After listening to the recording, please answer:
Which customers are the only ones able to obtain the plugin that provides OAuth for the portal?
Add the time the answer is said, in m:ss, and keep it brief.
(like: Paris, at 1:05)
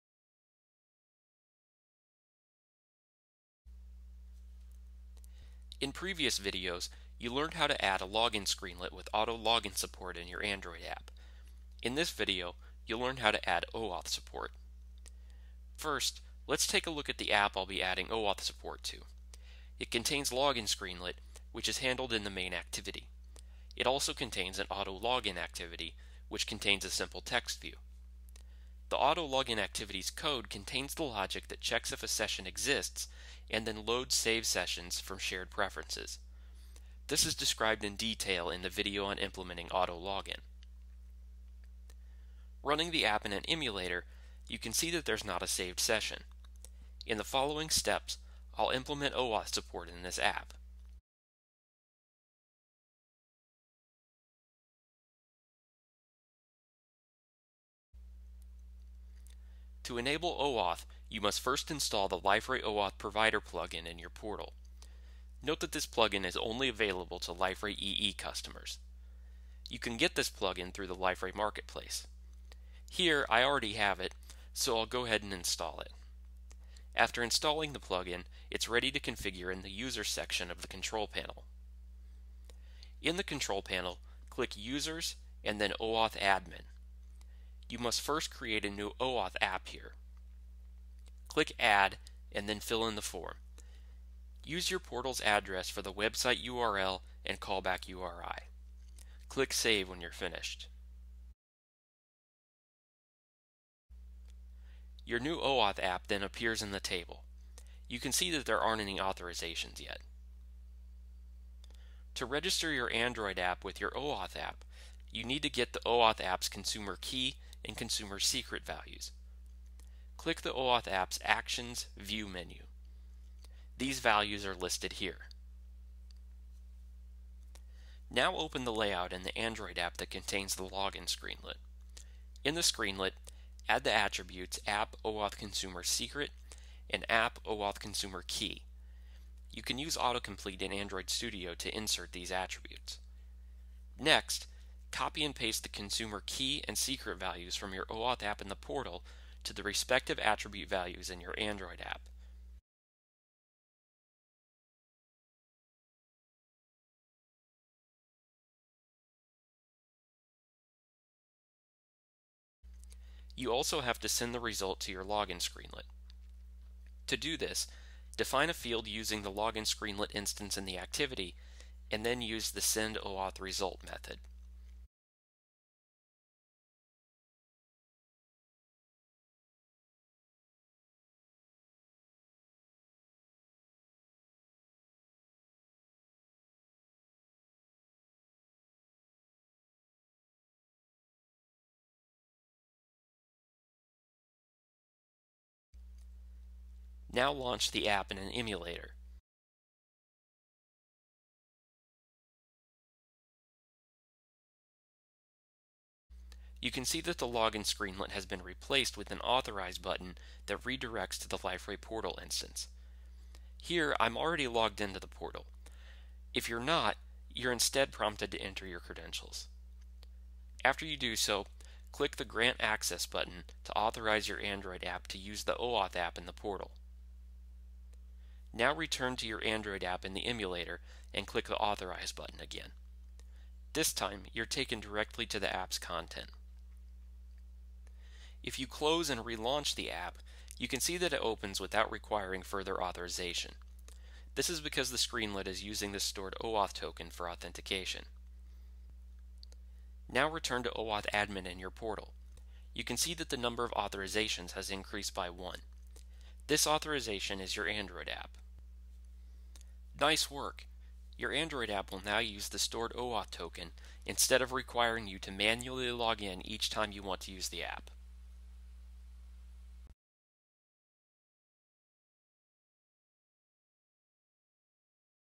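Liferay EE customers, at 1:07.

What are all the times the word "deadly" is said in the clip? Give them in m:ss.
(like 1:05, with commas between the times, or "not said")
not said.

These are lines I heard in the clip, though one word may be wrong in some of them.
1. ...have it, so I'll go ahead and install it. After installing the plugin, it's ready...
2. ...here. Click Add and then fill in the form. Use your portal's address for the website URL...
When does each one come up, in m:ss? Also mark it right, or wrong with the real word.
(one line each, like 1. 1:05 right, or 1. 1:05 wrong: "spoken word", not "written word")
1. 1:13 right
2. 1:29 right.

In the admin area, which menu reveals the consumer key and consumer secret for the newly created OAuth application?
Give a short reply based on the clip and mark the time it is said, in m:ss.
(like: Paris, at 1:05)
Actions View menu, at 2:01.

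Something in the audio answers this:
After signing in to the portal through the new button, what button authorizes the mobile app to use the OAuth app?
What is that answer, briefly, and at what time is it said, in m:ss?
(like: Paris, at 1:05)
Grant Access, at 3:42.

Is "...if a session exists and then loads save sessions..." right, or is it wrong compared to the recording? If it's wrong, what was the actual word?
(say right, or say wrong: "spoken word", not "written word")
right.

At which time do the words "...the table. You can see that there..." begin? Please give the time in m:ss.
1:46.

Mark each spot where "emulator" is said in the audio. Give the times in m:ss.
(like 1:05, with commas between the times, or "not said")
0:43, 3:18, 3:50.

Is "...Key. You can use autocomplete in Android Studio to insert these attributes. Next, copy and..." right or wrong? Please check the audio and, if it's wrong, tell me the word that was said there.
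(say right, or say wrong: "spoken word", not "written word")
right.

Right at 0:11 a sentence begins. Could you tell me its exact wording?
In this video, you'll learn how to add OAuth support.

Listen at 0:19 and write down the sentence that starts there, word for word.
It contains login screenlet, which is handled in the main activity.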